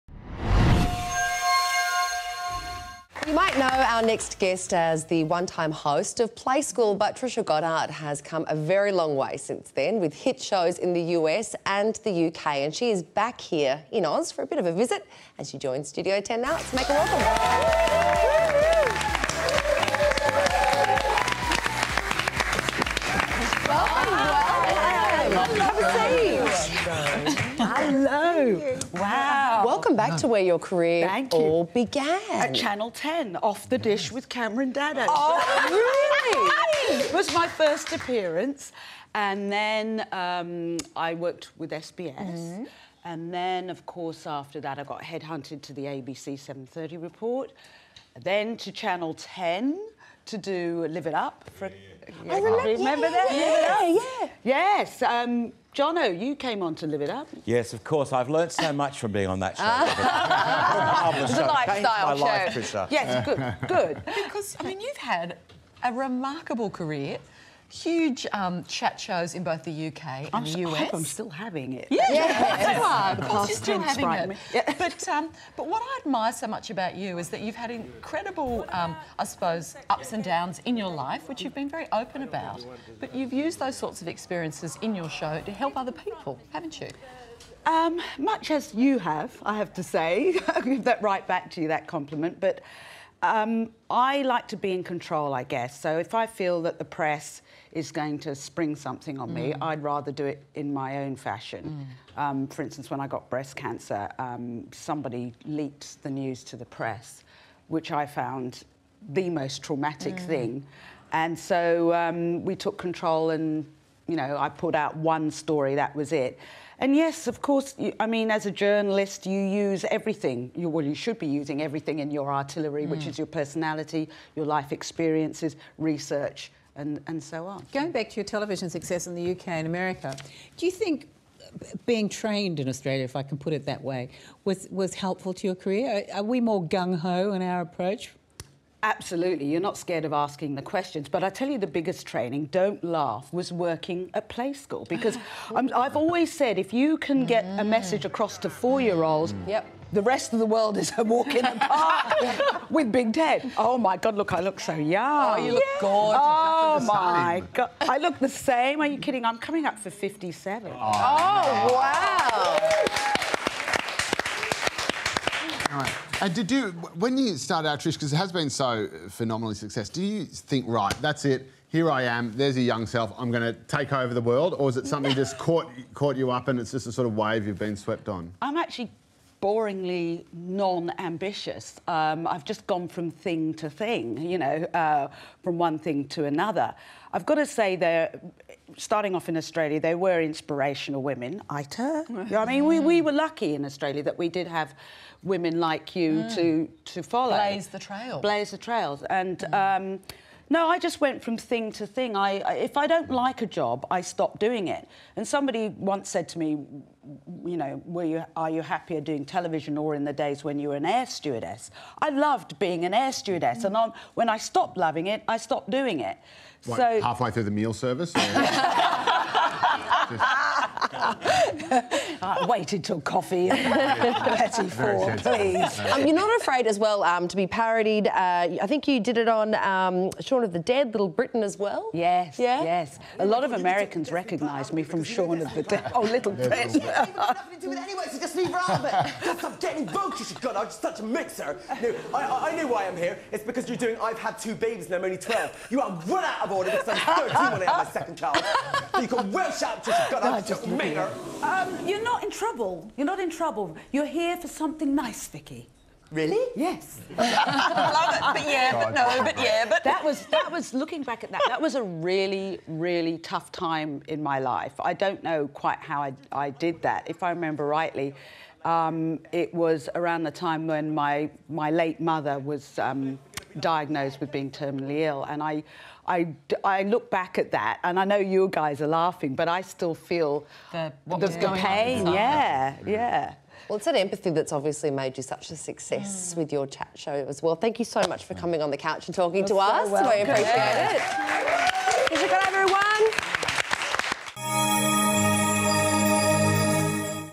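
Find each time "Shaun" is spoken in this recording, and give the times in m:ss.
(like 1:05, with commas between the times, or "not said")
3:50, 3:55.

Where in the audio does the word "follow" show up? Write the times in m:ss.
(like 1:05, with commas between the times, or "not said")
3:17.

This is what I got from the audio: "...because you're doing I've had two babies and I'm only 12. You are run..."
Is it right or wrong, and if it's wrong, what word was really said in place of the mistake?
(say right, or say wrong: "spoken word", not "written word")
right.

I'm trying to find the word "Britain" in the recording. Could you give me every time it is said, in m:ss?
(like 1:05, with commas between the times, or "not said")
3:51, 3:56.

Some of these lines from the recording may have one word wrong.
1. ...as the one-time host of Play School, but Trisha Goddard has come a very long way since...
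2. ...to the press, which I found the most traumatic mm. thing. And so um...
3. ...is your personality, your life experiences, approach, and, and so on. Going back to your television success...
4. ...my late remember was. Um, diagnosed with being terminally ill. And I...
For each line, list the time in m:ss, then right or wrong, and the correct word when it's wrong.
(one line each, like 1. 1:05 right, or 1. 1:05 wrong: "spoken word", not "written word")
1. 0:04 right
2. 1:46 right
3. 2:03 wrong: "research", not "approach"
4. 4:31 wrong: "mother", not "remember".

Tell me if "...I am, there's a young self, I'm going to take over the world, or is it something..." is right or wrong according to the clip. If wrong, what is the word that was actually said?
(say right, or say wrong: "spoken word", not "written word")
right.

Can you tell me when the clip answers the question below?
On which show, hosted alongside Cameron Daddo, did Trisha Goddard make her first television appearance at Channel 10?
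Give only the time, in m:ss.
0:33.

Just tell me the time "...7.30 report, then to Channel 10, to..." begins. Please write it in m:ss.
0:46.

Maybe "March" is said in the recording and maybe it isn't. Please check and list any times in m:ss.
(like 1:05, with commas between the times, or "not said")
not said.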